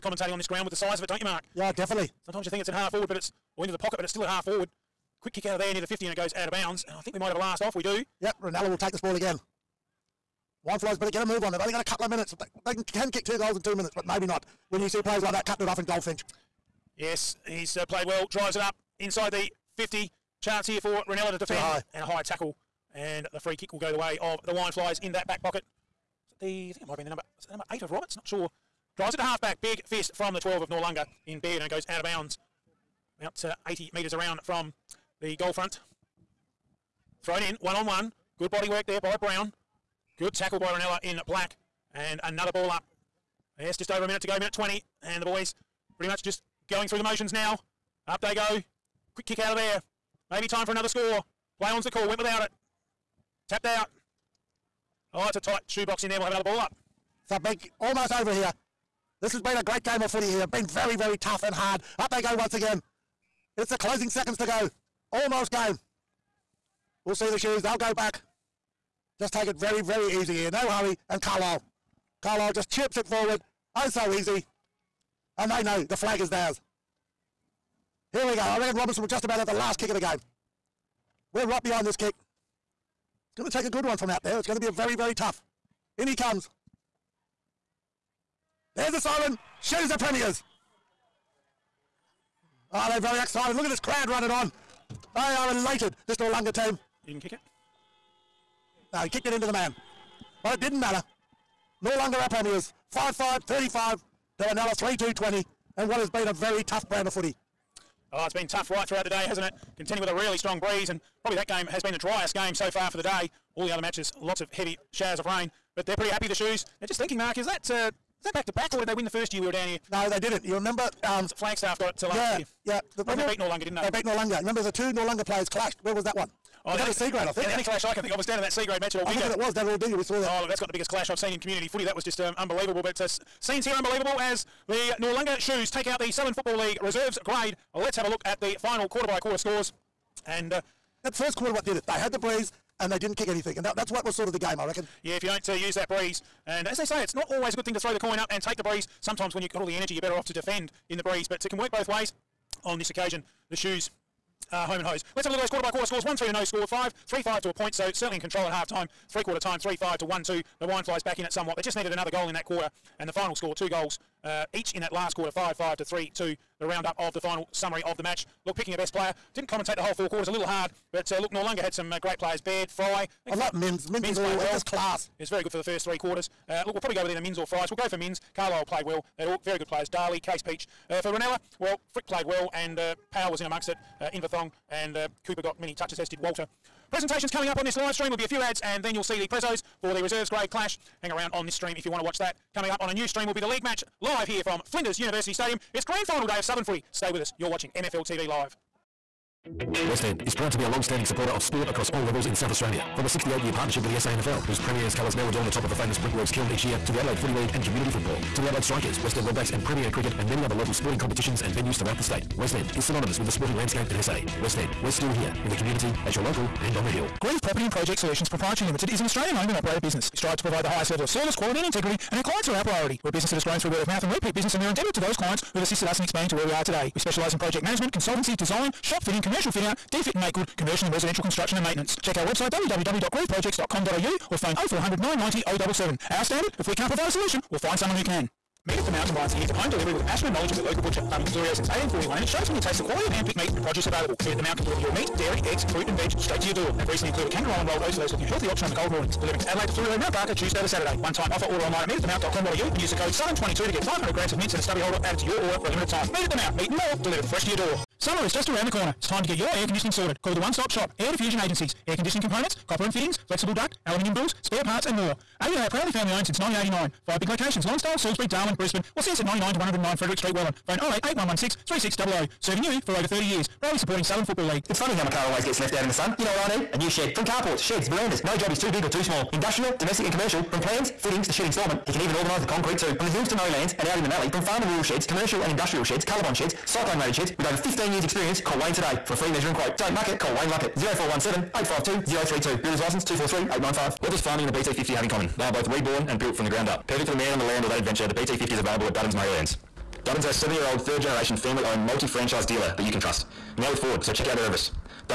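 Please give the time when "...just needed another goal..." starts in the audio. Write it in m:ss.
2:41.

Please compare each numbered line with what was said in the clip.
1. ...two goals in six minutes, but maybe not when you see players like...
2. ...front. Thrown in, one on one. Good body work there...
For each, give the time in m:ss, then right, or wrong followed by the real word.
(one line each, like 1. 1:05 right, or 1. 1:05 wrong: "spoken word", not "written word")
1. 0:13 wrong: "two", not "six"
2. 0:35 right.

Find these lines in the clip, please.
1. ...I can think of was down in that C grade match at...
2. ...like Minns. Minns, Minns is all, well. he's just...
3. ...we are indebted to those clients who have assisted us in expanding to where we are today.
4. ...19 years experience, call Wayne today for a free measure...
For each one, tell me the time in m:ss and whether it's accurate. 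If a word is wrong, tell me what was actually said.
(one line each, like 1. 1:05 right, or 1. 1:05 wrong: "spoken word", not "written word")
1. 2:07 right
2. 2:53 right
3. 3:44 right
4. 4:47 wrong: "15", not "19".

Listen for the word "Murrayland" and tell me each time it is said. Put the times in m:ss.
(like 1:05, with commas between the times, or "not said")
4:43, 4:59.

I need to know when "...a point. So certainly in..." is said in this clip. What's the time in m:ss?
2:37.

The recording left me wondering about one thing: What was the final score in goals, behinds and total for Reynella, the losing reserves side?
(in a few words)
3 2 20.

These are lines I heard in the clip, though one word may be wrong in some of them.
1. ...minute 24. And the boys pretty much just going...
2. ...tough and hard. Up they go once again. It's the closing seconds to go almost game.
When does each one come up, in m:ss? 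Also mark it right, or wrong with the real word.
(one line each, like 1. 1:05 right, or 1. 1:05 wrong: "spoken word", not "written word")
1. 0:44 wrong: "20", not "24"
2. 1:01 right.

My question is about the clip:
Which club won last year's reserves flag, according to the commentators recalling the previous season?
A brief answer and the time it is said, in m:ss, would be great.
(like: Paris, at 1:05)
Flagstaff, at 2:01.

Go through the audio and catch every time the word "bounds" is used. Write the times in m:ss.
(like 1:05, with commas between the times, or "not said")
0:06, 0:32.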